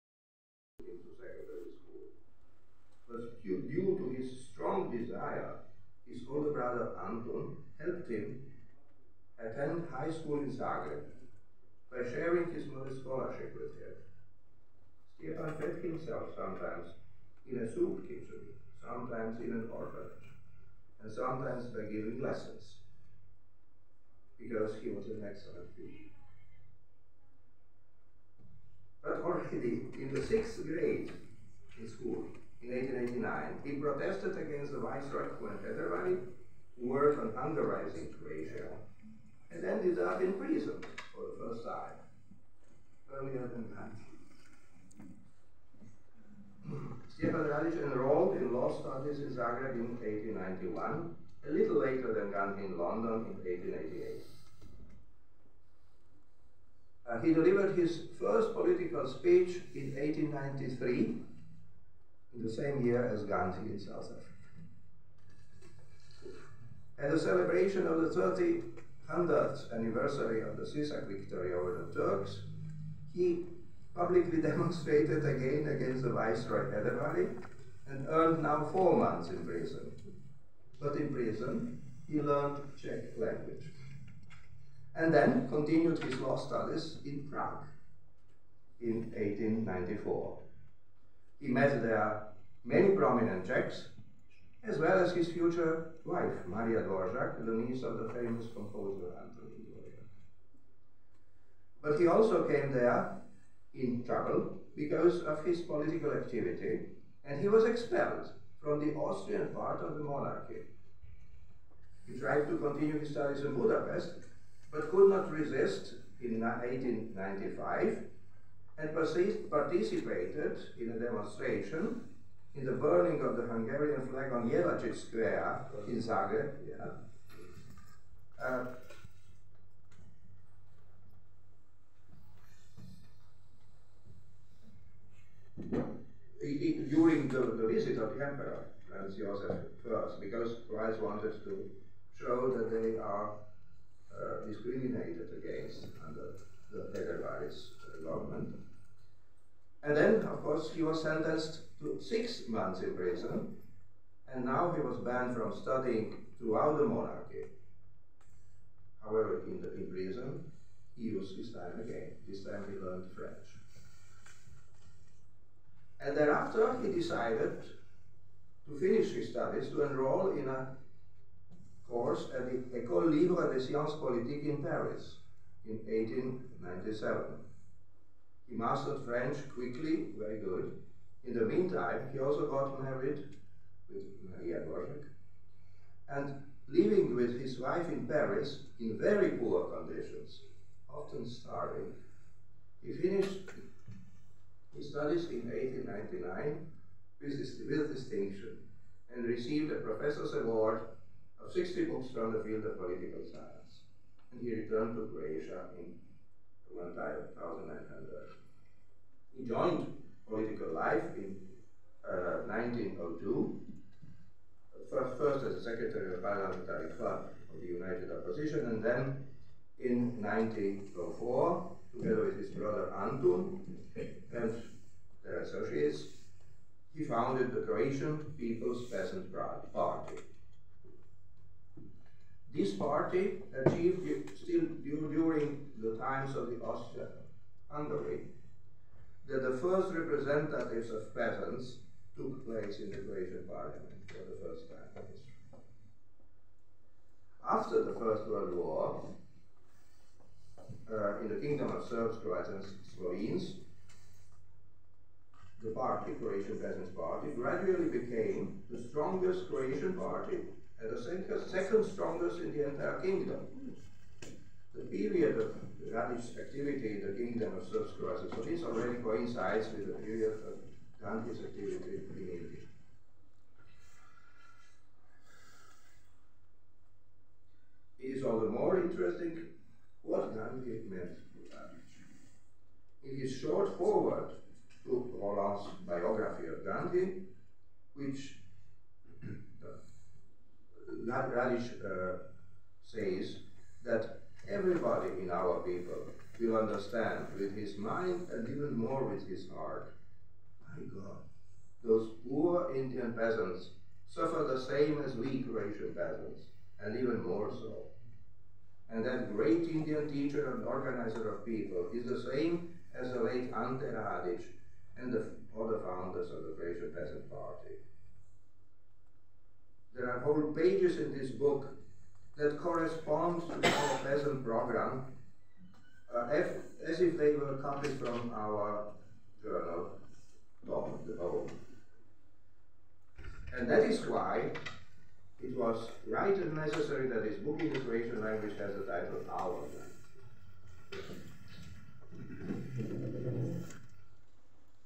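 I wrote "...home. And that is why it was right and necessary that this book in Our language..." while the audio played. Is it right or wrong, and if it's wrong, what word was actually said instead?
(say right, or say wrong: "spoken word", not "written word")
wrong: "Croatian", not "Our".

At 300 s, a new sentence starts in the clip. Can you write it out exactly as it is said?
My God, those poor Indian peasants suffer the same as we Croatian peasants, and even more so.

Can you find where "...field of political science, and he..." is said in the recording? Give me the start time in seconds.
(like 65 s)
202 s.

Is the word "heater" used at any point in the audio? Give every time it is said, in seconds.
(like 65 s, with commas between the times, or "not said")
not said.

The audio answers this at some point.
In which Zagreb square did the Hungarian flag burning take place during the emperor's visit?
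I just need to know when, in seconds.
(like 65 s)
124 s.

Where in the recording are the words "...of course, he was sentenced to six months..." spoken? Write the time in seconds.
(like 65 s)
150 s.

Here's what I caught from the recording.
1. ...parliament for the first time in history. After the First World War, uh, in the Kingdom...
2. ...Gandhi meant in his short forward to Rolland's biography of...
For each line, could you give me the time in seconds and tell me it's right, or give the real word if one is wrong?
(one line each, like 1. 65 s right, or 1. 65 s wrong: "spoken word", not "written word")
1. 243 s right
2. 280 s right.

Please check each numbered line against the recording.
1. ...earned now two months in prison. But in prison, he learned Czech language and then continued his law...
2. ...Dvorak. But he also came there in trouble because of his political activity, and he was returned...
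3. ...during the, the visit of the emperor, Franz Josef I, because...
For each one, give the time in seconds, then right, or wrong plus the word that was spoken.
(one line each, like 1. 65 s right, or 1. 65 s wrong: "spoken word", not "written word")
1. 78 s wrong: "four", not "two"
2. 99 s wrong: "expelled", not "returned"
3. 136 s right.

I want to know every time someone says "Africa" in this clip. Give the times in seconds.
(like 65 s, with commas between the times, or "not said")
64 s.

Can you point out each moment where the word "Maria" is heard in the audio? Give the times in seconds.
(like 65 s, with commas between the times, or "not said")
96 s, 184 s.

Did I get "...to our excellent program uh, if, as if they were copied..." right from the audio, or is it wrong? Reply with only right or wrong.
wrong.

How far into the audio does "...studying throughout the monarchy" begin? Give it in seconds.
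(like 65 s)
155 s.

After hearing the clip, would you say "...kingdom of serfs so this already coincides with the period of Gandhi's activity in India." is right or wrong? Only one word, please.
right.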